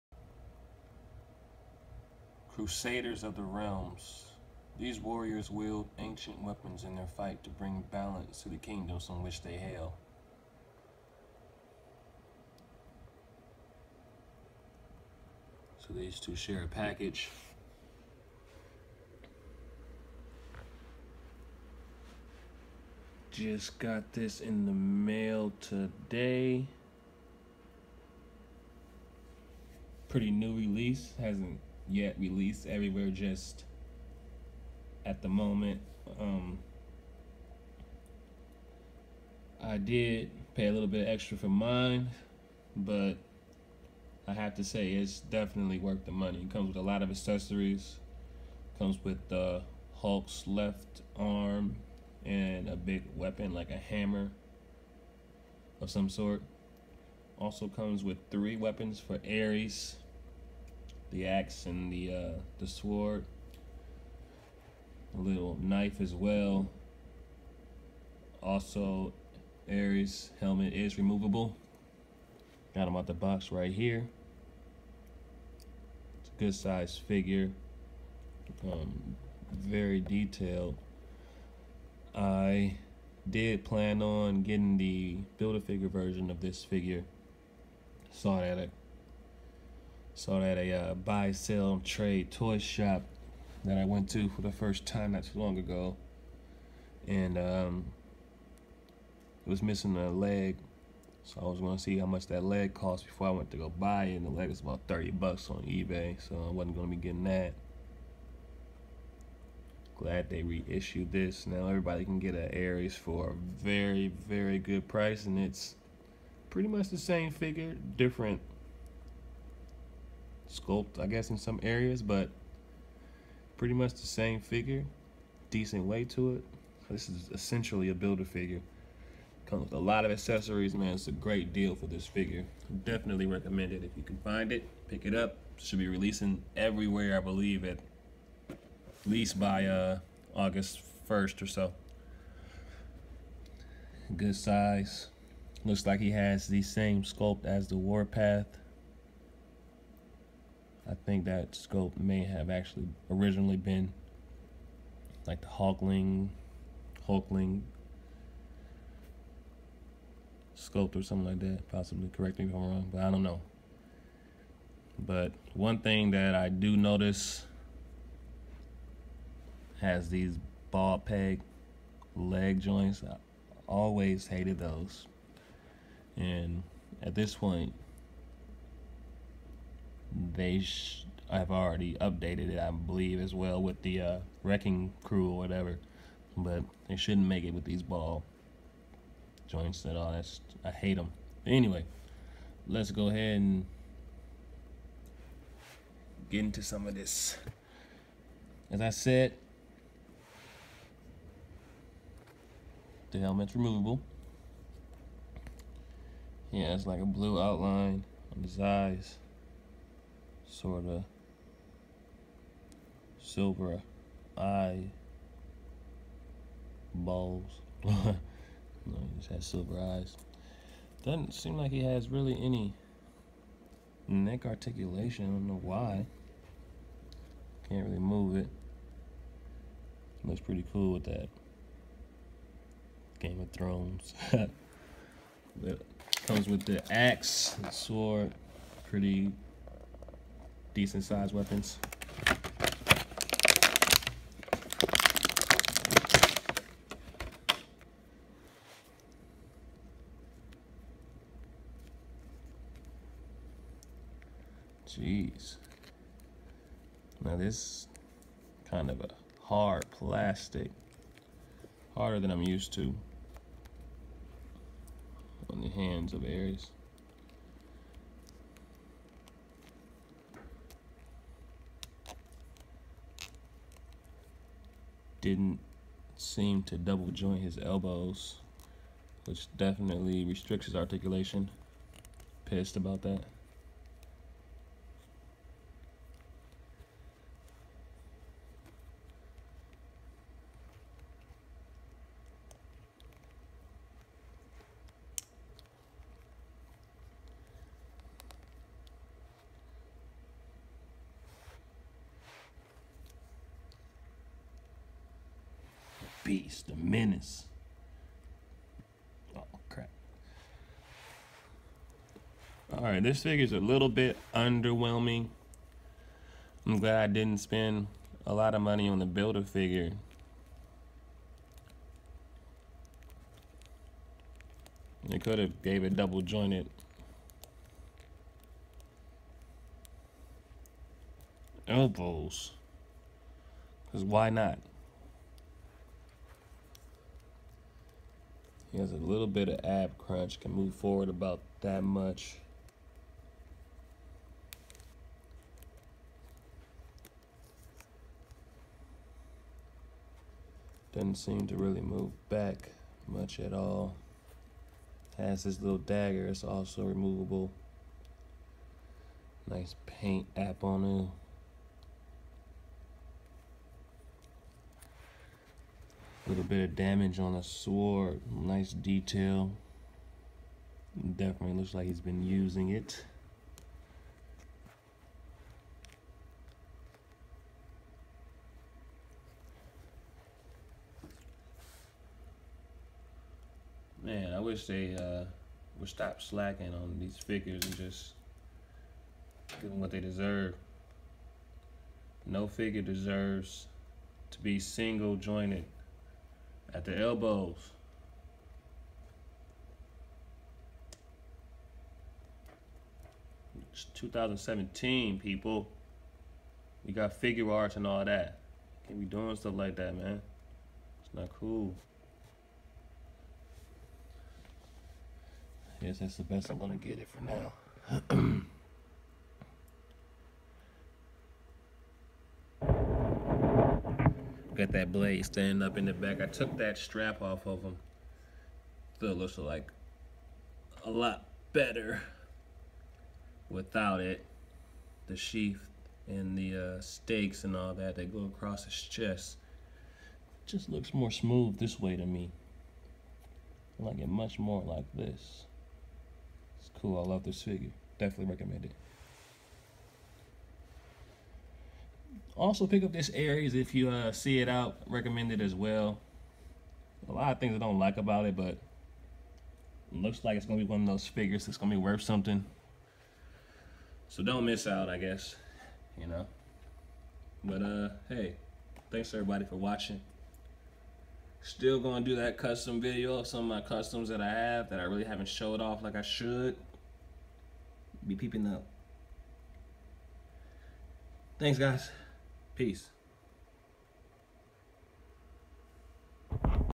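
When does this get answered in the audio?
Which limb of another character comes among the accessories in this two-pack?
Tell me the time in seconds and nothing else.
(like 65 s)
50 s.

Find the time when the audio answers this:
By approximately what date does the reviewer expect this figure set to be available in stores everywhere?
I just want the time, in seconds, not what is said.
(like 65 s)
140 s.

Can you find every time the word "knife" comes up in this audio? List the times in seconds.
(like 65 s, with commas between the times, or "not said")
65 s.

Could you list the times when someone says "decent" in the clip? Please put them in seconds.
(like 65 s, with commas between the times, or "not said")
125 s, 240 s.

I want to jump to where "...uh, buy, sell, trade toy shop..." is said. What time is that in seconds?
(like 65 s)
90 s.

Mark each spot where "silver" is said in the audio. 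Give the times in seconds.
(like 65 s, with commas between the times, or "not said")
213 s, 219 s.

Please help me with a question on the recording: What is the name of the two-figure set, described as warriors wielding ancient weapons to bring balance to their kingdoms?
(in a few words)
Crusaders of the Realms.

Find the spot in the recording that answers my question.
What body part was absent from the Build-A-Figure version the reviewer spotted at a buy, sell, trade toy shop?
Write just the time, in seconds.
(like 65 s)
99 s.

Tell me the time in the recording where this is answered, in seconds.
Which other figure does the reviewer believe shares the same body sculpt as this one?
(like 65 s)
147 s.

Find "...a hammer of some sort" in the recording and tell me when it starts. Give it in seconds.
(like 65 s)
53 s.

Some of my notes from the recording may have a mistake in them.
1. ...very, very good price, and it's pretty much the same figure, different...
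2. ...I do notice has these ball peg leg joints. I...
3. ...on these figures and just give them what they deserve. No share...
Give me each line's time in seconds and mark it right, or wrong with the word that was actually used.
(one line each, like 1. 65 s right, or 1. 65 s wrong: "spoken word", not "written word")
1. 113 s right
2. 166 s right
3. 386 s wrong: "figure", not "share".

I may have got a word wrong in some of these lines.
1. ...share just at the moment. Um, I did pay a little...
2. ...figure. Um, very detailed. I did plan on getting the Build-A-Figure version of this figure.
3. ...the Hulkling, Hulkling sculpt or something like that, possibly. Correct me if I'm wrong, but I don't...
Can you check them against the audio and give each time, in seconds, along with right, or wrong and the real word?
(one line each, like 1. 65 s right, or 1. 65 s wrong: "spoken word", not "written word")
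1. 32 s wrong: "everywhere", not "share"
2. 76 s right
3. 155 s right.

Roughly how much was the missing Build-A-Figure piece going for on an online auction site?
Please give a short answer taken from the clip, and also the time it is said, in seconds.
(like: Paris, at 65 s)
$30, at 104 s.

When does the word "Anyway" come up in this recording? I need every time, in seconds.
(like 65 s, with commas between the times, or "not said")
191 s.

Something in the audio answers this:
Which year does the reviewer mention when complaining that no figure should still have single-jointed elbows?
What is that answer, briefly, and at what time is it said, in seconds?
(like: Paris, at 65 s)
2017, at 403 s.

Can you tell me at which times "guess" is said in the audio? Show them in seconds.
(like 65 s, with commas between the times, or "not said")
121 s, 464 s.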